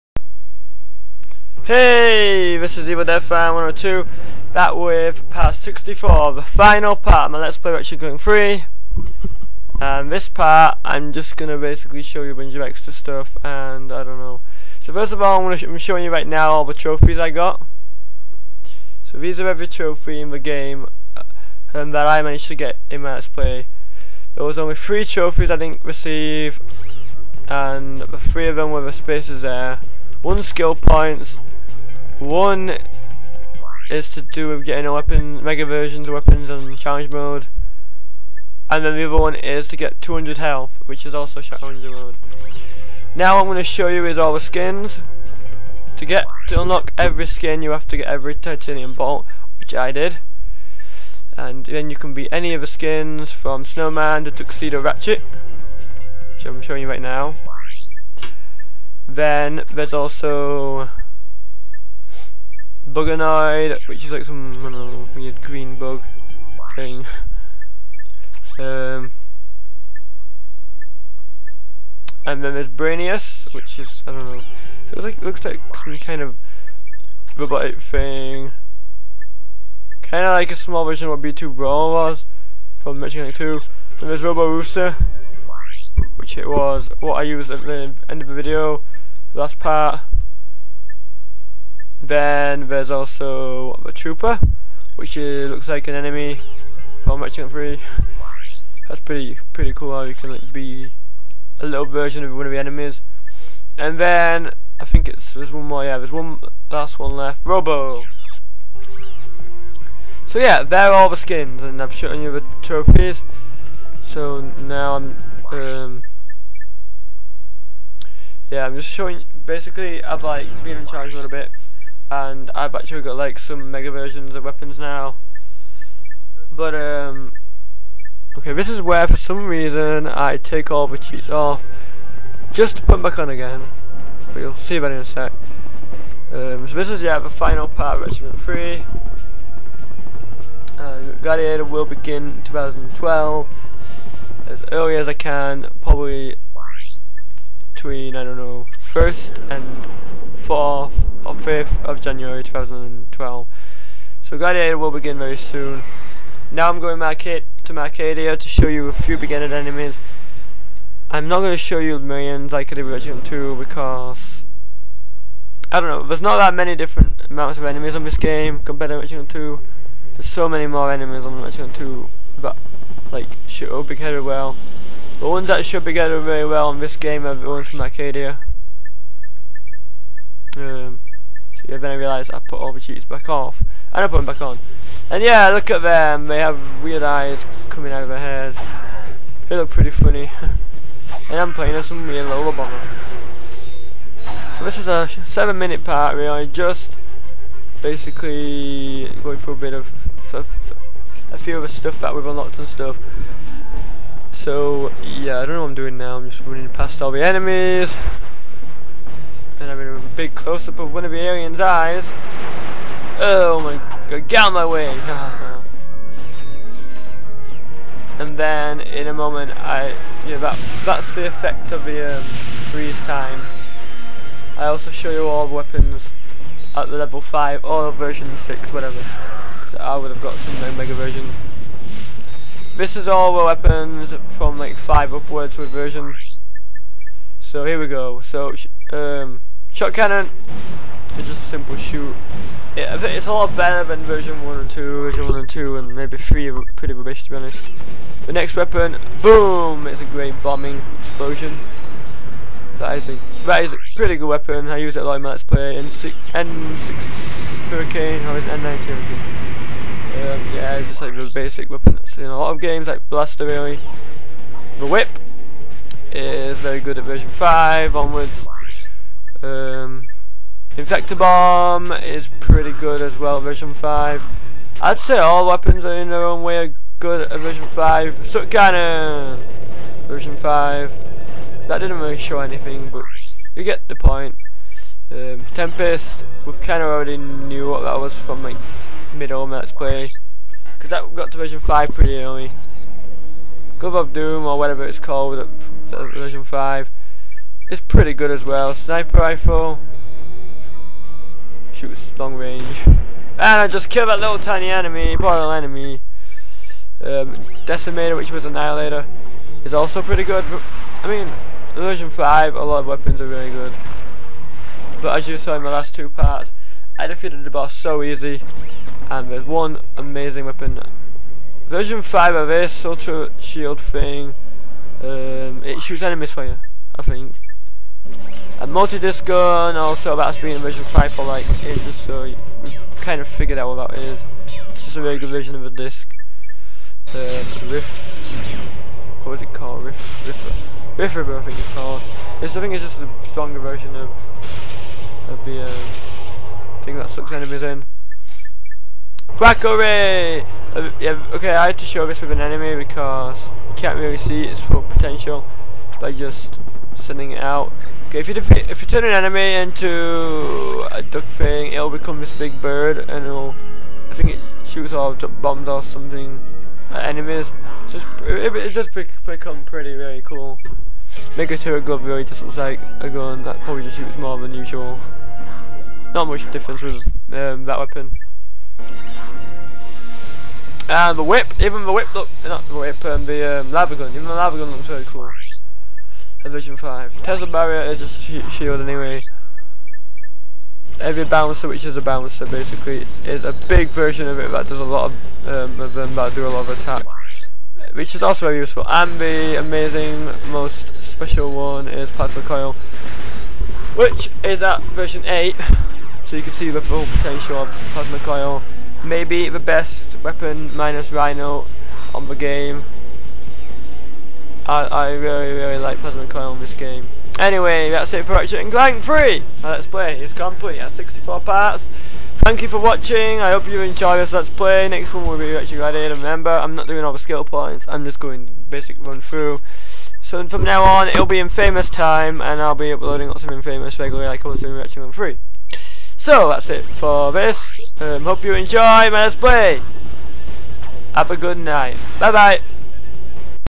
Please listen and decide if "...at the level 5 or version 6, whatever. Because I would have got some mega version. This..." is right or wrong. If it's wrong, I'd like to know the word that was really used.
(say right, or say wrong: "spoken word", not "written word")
right.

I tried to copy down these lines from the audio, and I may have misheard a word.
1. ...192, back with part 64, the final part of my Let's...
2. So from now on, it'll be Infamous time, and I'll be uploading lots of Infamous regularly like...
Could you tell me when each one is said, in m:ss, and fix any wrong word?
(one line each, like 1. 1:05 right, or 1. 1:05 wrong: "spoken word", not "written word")
1. 0:03 wrong: "102", not "192"
2. 7:10 right.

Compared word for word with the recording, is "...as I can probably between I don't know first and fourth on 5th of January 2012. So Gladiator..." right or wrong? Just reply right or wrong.
right.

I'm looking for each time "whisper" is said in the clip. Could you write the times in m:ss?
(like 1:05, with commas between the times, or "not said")
not said.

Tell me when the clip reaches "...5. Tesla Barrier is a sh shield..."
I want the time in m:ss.
6:26.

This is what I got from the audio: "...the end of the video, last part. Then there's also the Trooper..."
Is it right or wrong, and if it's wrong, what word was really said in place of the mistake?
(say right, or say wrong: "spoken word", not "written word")
right.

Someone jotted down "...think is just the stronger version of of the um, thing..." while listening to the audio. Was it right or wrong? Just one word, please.
right.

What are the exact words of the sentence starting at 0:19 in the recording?
So these are every trophy in the game um, that I managed to get in my Let's Play.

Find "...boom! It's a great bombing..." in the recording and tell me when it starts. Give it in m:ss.
4:09.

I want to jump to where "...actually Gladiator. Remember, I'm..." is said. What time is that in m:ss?
7:05.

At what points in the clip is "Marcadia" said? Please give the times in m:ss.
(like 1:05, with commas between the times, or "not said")
2:37, 2:57.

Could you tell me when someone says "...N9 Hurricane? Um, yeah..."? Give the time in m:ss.
4:18.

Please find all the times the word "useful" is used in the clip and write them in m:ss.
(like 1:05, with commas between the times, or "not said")
6:38.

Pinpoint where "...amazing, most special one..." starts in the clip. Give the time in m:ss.
6:39.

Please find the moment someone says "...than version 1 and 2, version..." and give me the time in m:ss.
4:03.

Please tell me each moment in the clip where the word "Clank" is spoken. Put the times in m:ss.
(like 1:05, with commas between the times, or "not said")
0:07, 6:58, 7:14.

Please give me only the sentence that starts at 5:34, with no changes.
It's just a really good version of a disc.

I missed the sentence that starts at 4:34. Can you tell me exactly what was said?
I'd say all weapons are in their own way are good at uh, version 5.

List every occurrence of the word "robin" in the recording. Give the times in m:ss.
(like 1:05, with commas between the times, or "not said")
not said.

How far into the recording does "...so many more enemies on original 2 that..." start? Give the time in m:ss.
2:50.